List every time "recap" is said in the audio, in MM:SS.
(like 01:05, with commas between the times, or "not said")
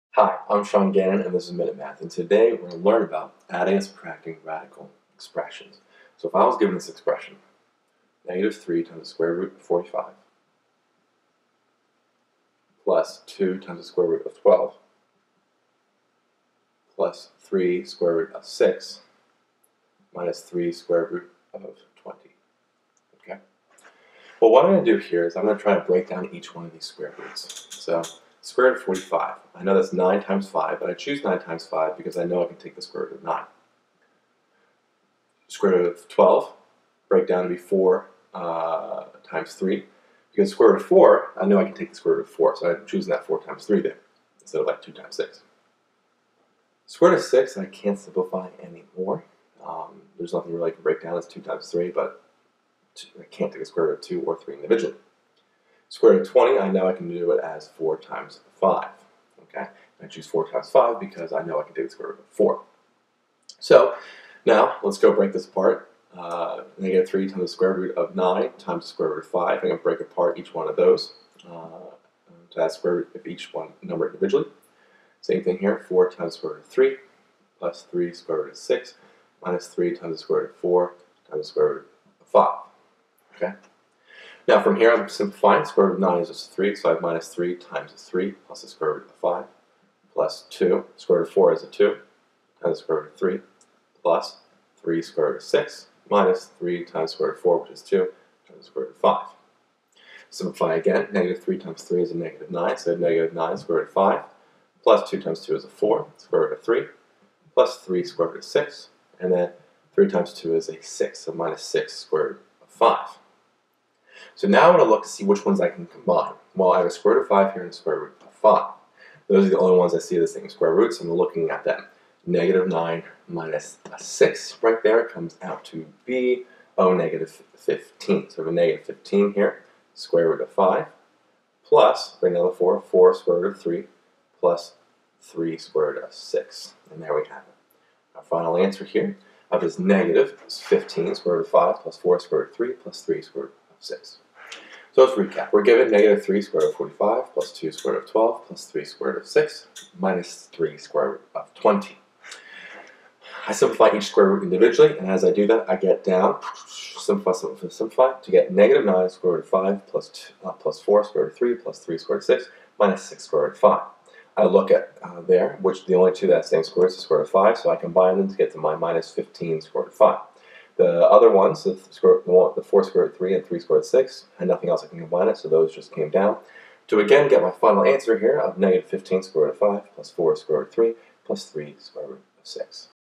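02:25.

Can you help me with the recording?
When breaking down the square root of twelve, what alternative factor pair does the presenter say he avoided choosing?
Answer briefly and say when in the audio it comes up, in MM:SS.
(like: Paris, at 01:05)
2 times 6, at 00:44.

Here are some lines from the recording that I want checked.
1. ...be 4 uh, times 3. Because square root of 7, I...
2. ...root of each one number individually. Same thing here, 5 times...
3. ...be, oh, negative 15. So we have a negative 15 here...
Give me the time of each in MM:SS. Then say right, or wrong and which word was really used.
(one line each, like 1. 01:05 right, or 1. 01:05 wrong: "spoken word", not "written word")
1. 00:37 wrong: "4", not "7"
2. 01:12 wrong: "4", not "5"
3. 02:06 right.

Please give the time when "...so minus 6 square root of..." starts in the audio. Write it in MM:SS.
01:51.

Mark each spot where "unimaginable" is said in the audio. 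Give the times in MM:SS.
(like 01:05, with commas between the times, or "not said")
not said.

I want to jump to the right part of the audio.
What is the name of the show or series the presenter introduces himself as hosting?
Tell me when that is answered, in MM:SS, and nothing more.
00:01.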